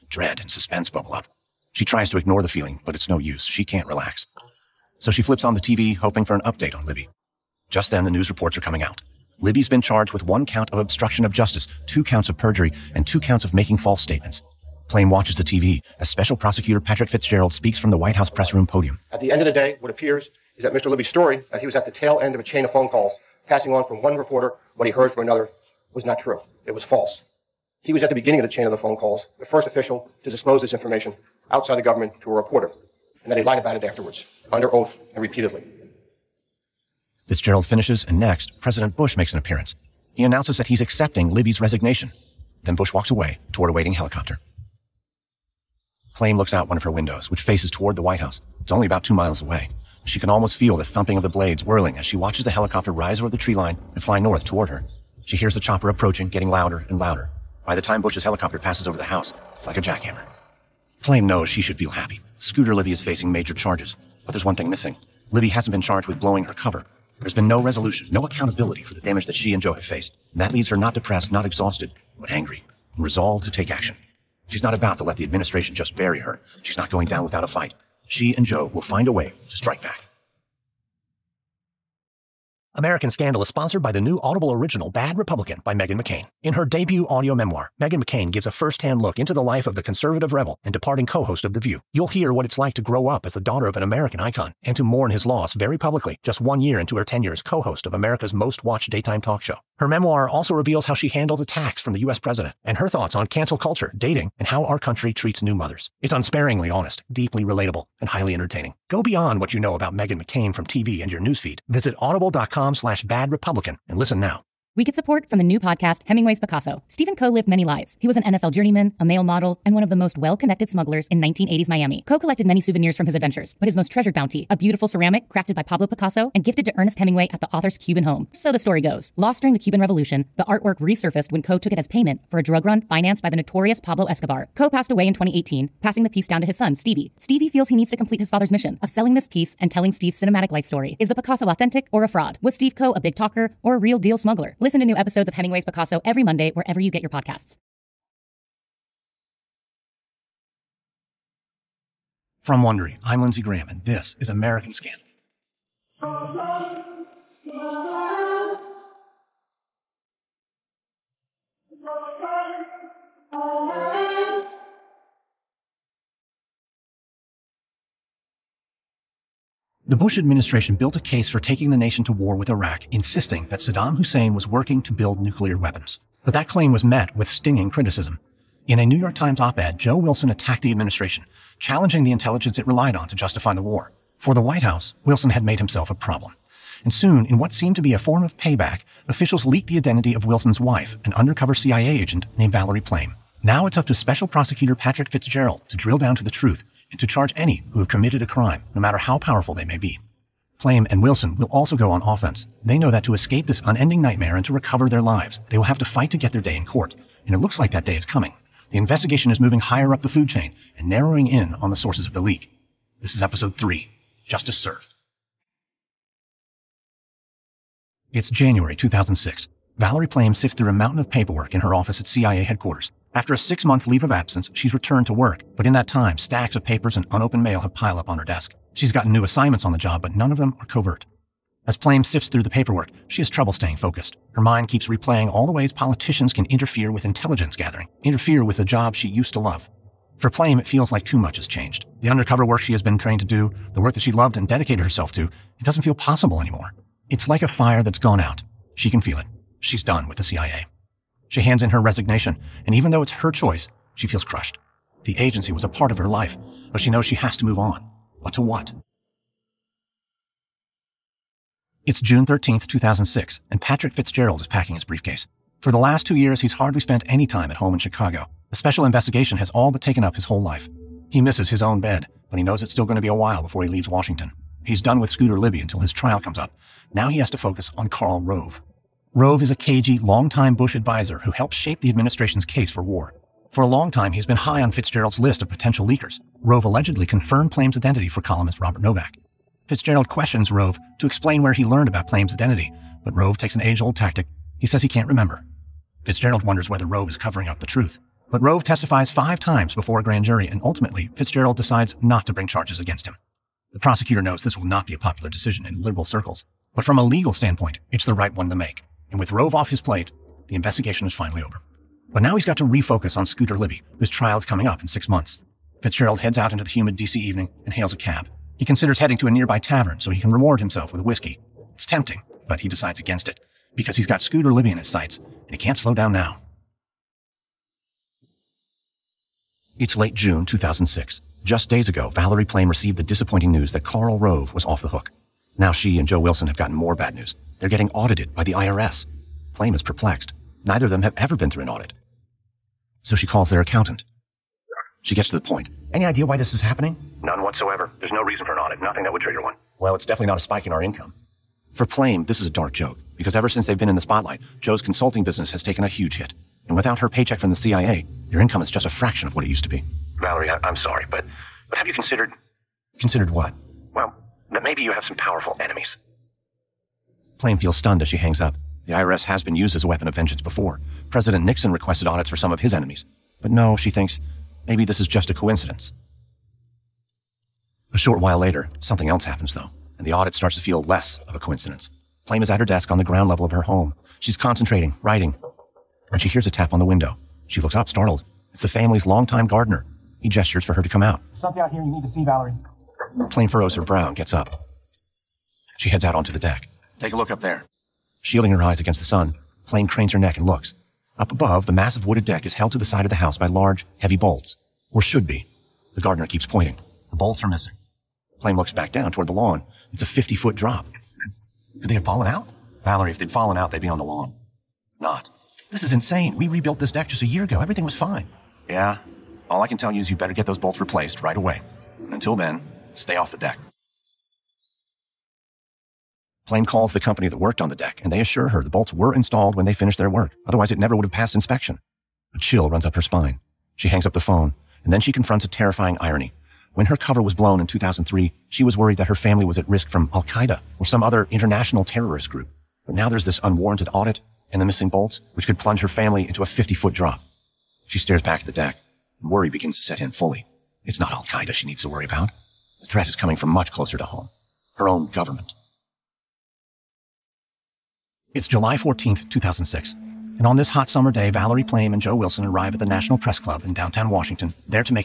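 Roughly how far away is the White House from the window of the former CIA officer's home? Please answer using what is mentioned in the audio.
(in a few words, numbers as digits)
2 miles.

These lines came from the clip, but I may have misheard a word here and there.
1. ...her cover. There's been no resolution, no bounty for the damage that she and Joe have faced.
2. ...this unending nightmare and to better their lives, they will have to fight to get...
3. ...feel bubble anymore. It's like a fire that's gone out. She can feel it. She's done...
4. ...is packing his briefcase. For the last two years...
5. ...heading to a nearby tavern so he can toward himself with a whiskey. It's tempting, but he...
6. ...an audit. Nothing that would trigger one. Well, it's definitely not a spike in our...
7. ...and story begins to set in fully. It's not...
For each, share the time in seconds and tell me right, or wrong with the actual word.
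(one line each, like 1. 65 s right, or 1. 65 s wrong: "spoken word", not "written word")
1. 66 s wrong: "accountability", not "bounty"
2. 203 s wrong: "recover", not "better"
3. 245 s wrong: "possible", not "bubble"
4. 264 s right
5. 318 s wrong: "reward", not "toward"
6. 348 s right
7. 449 s wrong: "worry", not "story".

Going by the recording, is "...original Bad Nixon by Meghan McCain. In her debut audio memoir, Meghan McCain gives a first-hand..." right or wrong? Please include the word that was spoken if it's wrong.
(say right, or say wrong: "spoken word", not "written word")
wrong: "Republican", not "Nixon".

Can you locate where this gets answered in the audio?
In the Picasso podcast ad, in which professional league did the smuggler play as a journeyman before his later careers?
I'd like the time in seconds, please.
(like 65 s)
118 s.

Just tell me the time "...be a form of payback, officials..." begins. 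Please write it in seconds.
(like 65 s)
187 s.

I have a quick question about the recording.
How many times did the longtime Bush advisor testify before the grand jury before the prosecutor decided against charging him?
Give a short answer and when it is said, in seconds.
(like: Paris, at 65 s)
5, at 299 s.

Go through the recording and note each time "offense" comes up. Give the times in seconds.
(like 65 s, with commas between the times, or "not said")
202 s.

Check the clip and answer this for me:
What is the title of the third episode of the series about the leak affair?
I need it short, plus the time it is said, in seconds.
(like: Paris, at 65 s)
Justice Served, at 214 s.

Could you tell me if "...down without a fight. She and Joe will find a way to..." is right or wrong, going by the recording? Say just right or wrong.
right.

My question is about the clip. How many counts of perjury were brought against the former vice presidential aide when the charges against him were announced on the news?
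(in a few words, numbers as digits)
2.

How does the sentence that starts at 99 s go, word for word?
Her memoir also reveals how she handled attacks from the U.S.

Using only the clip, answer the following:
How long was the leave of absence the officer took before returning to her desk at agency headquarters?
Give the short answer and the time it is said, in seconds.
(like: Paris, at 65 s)
6 months, at 223 s.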